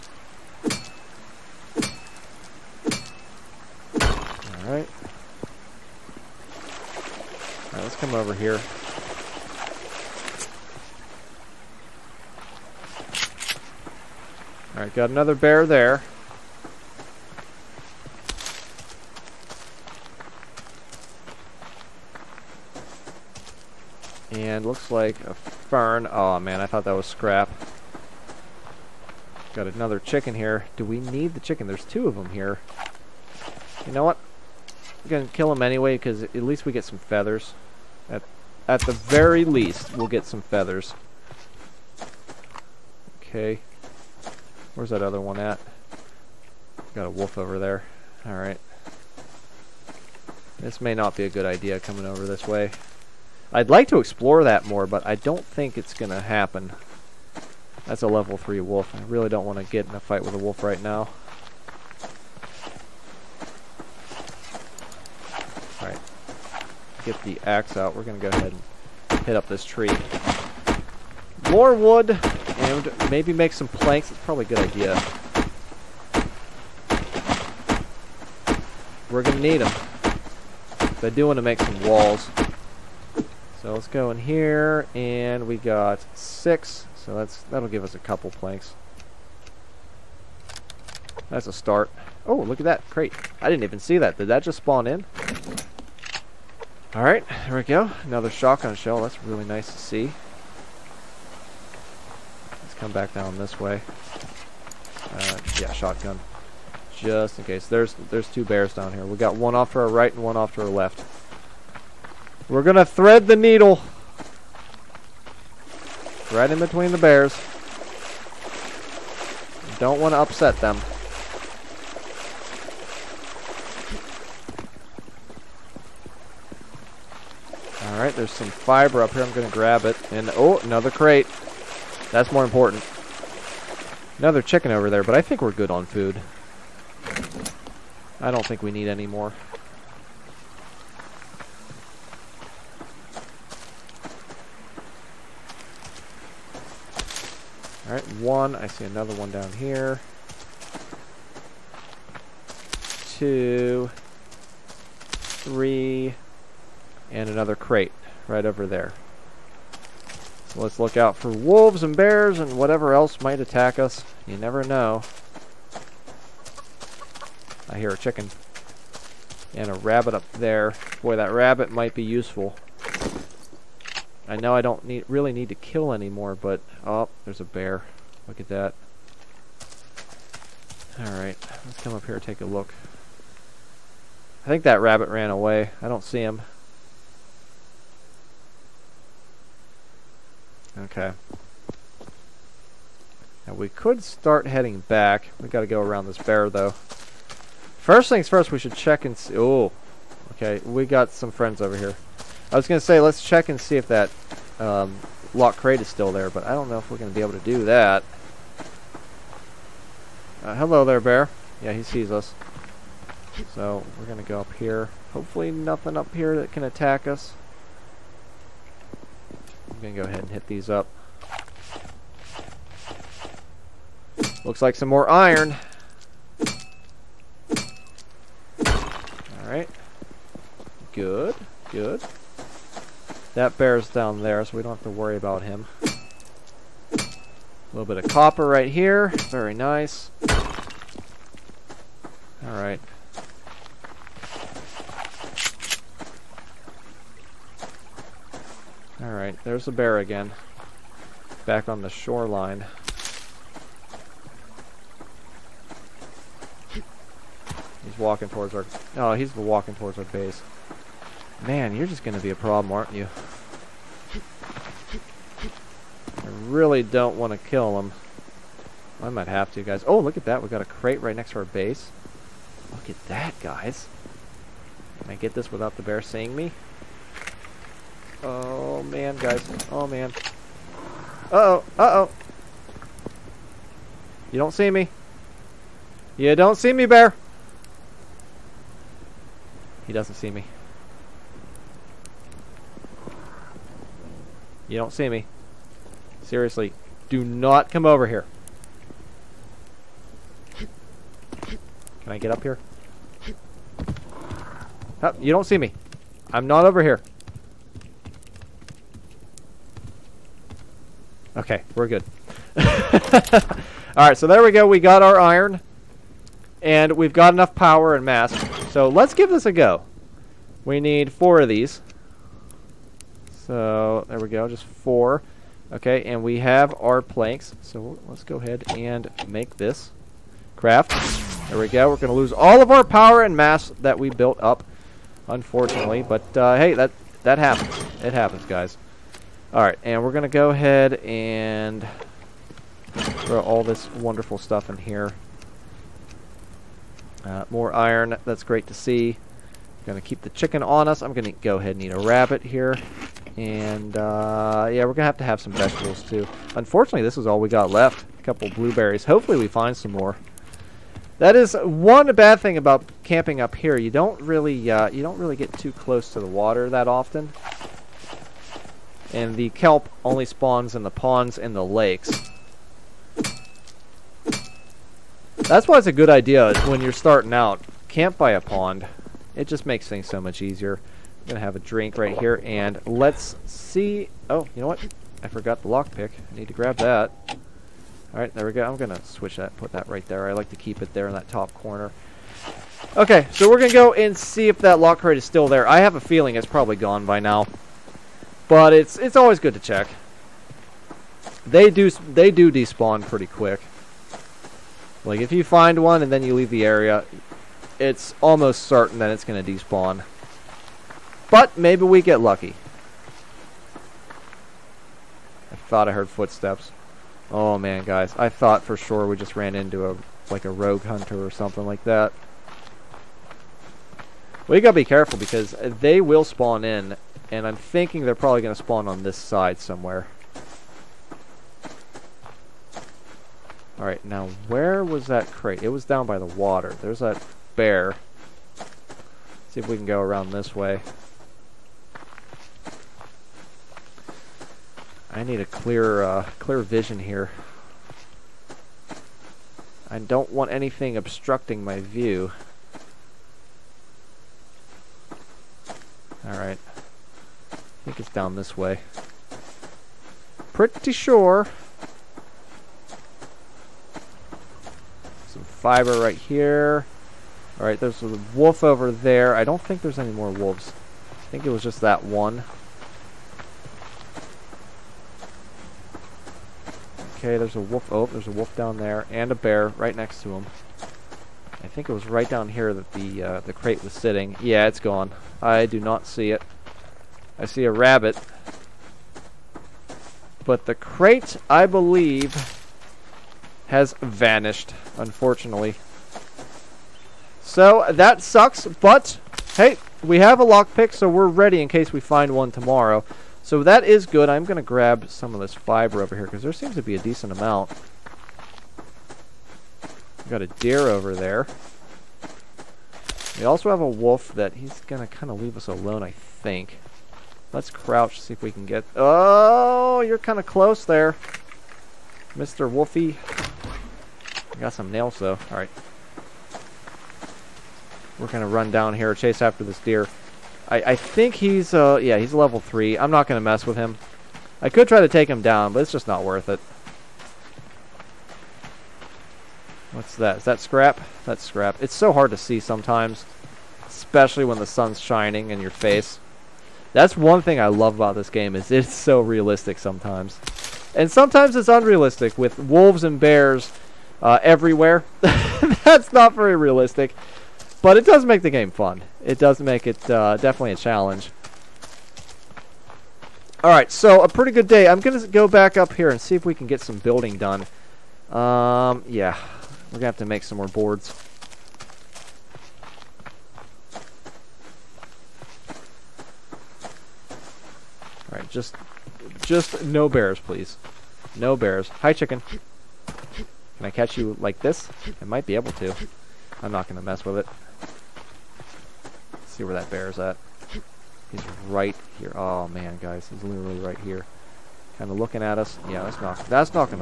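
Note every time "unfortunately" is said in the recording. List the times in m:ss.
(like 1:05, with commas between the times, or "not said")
5:35, 5:56, 8:14.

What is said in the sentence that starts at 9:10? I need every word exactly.
And sometimes it's unrealistic with wolves and bears uh, everywhere.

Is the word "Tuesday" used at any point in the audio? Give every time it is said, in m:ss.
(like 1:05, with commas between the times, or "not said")
not said.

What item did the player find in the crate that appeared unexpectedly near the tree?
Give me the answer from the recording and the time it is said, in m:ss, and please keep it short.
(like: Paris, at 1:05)
Shotgun shell, at 1:38.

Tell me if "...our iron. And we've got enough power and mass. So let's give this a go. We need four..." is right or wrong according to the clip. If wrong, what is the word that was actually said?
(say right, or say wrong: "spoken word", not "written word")
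right.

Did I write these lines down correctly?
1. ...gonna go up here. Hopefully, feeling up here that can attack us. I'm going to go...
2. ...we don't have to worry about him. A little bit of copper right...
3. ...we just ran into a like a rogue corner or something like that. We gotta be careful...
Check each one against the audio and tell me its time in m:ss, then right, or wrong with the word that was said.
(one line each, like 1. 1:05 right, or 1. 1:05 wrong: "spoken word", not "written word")
1. 3:34 wrong: "nothing", not "feeling"
2. 3:54 right
3. 6:59 wrong: "hunter", not "corner".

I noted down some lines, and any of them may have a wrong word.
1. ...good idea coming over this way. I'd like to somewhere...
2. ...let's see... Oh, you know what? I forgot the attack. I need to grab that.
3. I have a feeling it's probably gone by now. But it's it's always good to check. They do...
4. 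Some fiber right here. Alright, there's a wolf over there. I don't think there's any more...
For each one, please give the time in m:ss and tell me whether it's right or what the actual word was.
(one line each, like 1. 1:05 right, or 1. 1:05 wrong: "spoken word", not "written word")
1. 0:51 wrong: "explore", not "somewhere"
2. 6:22 wrong: "lockpick", not "attack"
3. 6:35 right
4. 7:45 right.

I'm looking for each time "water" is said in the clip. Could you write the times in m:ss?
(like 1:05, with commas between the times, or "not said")
6:06, 7:16.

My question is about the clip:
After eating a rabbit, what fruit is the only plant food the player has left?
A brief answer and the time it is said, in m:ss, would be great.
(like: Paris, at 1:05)
Blueberries, at 5:58.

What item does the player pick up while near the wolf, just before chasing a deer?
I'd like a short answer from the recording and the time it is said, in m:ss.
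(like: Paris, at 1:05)
Nails, at 8:44.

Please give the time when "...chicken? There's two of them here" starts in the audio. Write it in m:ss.
0:31.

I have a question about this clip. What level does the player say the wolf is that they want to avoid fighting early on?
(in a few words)
3.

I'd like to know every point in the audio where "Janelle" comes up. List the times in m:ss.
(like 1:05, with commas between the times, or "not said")
not said.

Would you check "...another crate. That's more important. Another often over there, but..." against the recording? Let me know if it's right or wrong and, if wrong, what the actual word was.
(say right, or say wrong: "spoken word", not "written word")
wrong: "chicken", not "often".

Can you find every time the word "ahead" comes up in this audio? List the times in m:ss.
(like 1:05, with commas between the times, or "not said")
1:08, 3:40, 5:28, 5:40, 5:51.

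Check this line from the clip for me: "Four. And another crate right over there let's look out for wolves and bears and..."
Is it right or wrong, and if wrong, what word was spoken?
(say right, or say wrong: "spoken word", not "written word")
wrong: "Three", not "Four".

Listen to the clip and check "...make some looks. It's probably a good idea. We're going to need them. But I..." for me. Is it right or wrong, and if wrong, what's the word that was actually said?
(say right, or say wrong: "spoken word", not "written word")
wrong: "planks", not "looks".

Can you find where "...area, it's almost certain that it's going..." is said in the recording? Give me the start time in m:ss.
6:46.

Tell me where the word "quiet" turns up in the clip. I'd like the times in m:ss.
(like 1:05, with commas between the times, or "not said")
not said.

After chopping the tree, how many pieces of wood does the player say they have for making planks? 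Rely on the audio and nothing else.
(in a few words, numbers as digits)
6.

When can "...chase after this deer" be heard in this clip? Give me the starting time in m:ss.
8:49.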